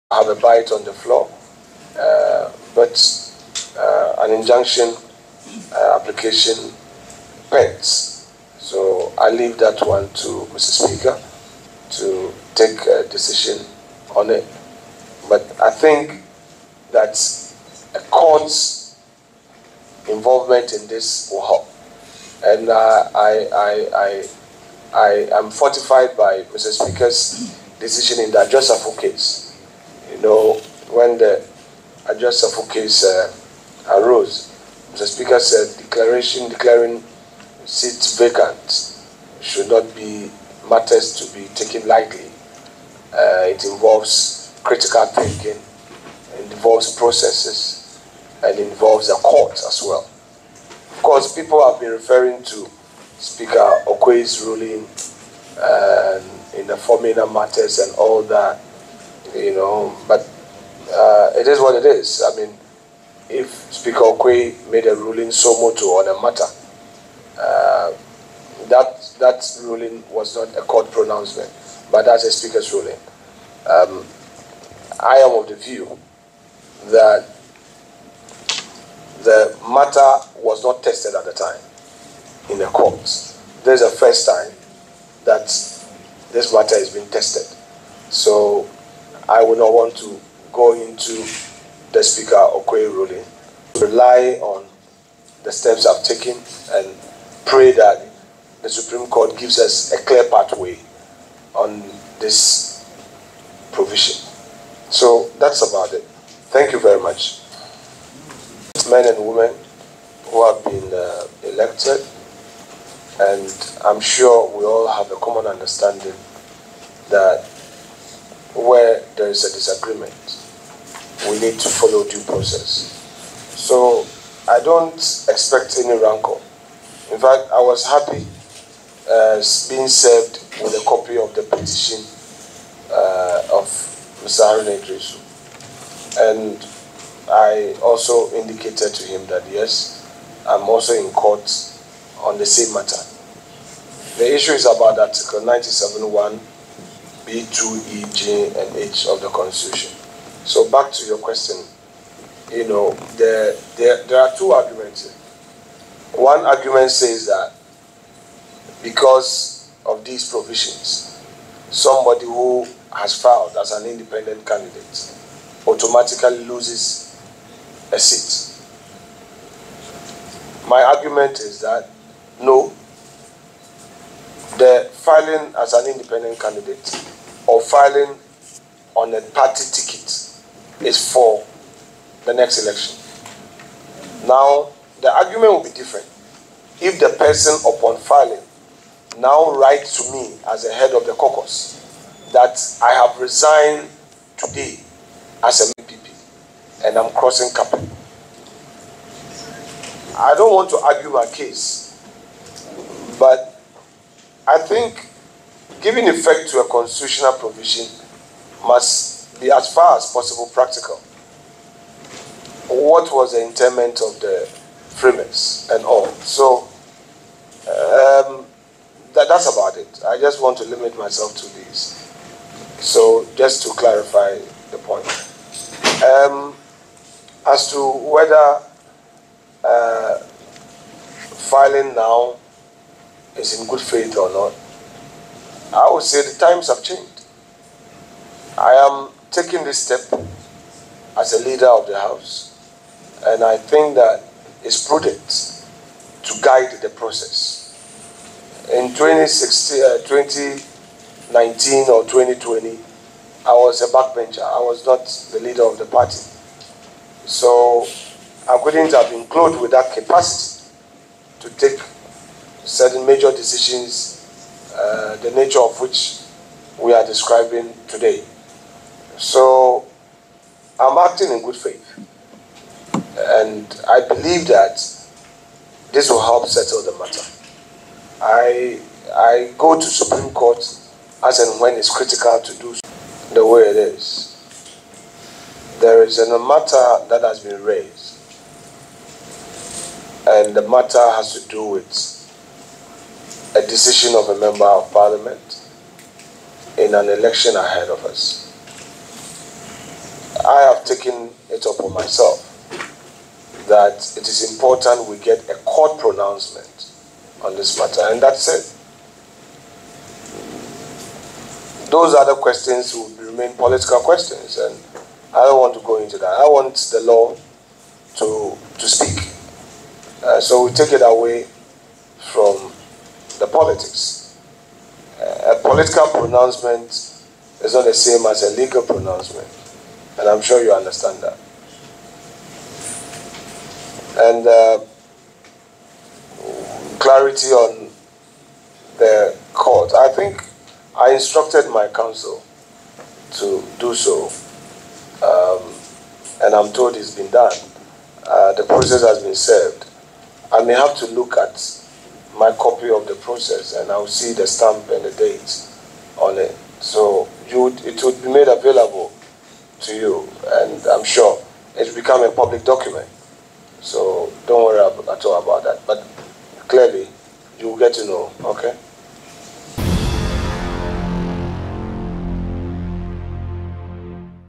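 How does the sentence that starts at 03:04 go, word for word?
Now, the argument will be different.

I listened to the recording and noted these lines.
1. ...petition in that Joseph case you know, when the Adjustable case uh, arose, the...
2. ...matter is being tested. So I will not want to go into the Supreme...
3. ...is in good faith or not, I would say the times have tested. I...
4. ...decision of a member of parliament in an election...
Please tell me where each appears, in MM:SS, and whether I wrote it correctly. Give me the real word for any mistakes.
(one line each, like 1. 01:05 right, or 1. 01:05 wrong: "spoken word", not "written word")
1. 00:27 wrong: "decision", not "petition"
2. 01:26 wrong: "Speaker", not "Supreme"
3. 03:53 wrong: "changed", not "tested"
4. 04:53 right.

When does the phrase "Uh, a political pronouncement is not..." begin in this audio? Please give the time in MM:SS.
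05:25.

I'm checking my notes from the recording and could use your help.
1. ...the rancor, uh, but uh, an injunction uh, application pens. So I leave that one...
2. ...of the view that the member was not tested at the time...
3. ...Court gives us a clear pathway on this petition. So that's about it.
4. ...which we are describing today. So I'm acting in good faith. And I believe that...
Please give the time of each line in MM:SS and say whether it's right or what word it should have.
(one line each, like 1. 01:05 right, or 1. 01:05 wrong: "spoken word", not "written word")
1. 00:00 wrong: "floor", not "rancor"
2. 01:15 wrong: "matter", not "member"
3. 01:39 wrong: "provision", not "petition"
4. 04:25 right.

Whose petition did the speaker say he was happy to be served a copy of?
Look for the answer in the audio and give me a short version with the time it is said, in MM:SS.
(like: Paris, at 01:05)
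Haruna Iddrisu, at 02:14.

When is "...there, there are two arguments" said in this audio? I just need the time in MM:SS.
02:33.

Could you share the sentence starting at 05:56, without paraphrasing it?
So you would, it would be made available to you and I'm sure it's become a public document.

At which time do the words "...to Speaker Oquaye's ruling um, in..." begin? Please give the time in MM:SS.
00:52.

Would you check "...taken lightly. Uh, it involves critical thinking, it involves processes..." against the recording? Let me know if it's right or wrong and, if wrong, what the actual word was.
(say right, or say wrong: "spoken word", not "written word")
right.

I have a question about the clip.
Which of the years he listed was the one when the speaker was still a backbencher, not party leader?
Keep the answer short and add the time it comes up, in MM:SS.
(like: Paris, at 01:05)
2016, at 04:08.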